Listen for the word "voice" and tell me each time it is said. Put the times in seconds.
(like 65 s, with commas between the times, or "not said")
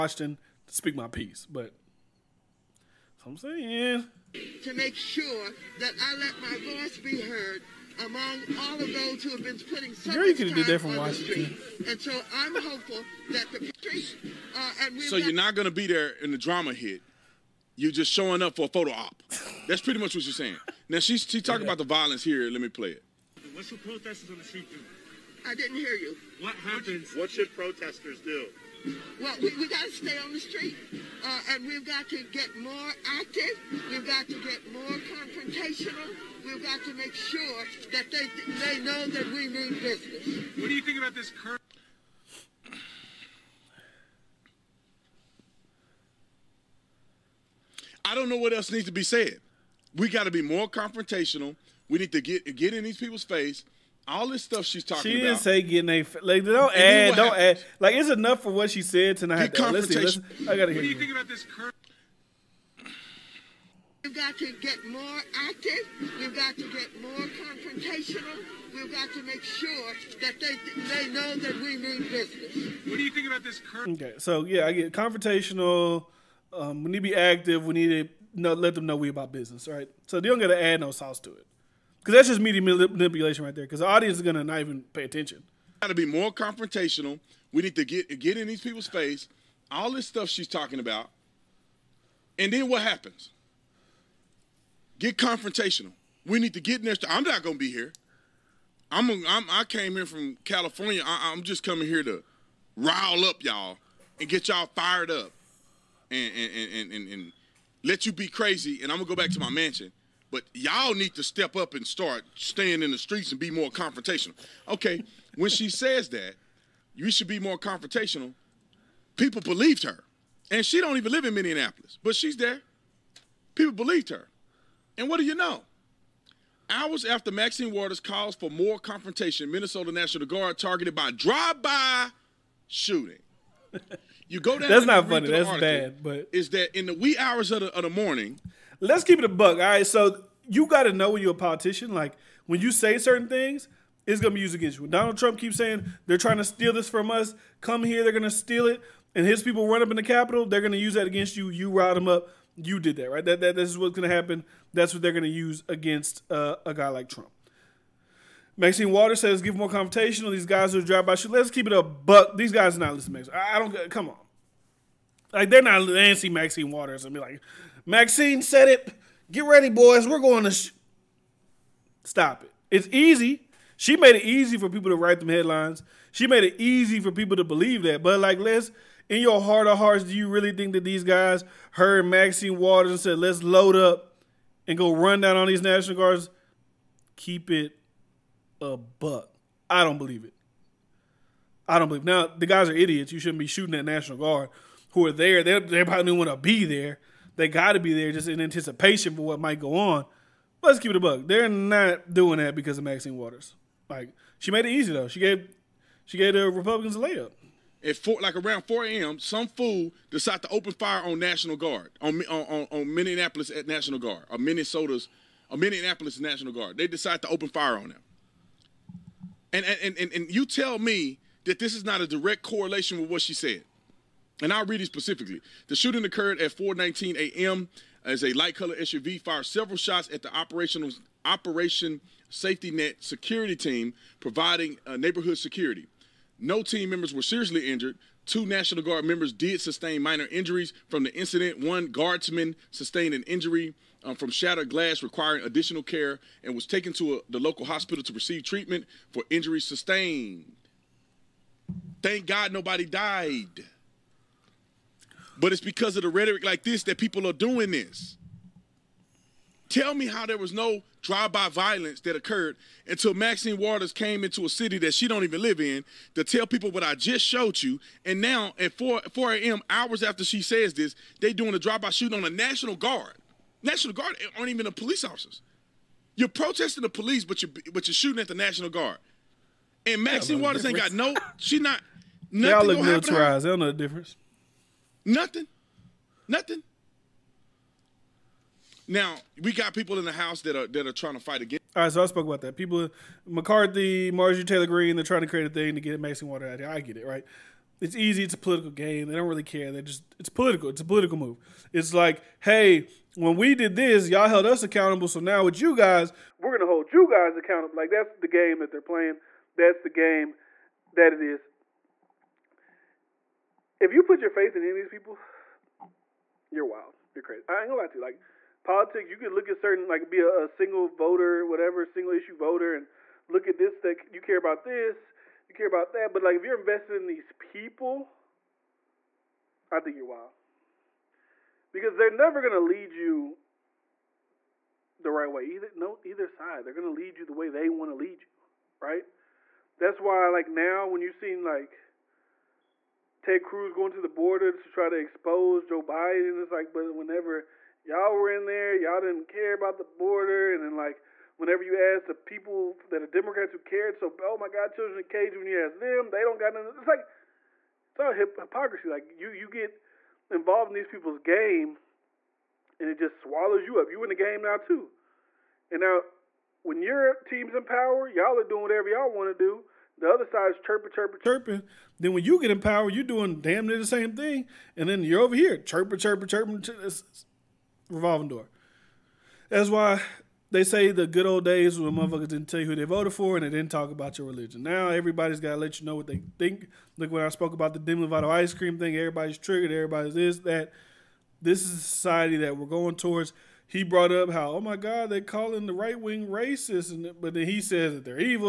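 6 s.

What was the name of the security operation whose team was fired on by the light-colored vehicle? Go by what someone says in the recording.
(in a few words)
Operation Safety Net.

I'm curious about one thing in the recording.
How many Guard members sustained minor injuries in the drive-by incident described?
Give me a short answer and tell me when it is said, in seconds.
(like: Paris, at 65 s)
2, at 238 s.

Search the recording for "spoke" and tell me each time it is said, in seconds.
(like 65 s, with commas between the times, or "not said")
292 s, 387 s.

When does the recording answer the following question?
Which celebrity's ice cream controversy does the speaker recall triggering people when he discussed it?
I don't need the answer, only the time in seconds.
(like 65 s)
387 s.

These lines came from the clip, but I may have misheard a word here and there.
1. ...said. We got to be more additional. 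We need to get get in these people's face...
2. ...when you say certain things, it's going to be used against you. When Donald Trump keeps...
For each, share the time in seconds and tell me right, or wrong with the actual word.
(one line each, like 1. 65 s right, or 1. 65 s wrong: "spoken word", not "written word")
1. 49 s wrong: "confrontational", not "additional"
2. 142 s right.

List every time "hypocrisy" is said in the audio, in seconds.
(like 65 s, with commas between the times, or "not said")
358 s.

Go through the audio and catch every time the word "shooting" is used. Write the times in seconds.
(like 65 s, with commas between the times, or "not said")
132 s, 193 s, 225 s, 271 s, 277 s.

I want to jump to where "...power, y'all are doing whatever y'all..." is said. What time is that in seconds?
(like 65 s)
367 s.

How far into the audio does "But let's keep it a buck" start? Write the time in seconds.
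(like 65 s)
200 s.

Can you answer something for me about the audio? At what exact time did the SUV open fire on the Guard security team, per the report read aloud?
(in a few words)
4:19 a.m.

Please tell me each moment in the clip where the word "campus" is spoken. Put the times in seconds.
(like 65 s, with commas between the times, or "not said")
not said.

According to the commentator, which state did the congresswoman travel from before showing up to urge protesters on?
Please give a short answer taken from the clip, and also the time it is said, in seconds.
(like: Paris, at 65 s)
California, at 100 s.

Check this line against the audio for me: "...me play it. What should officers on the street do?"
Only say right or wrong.
wrong.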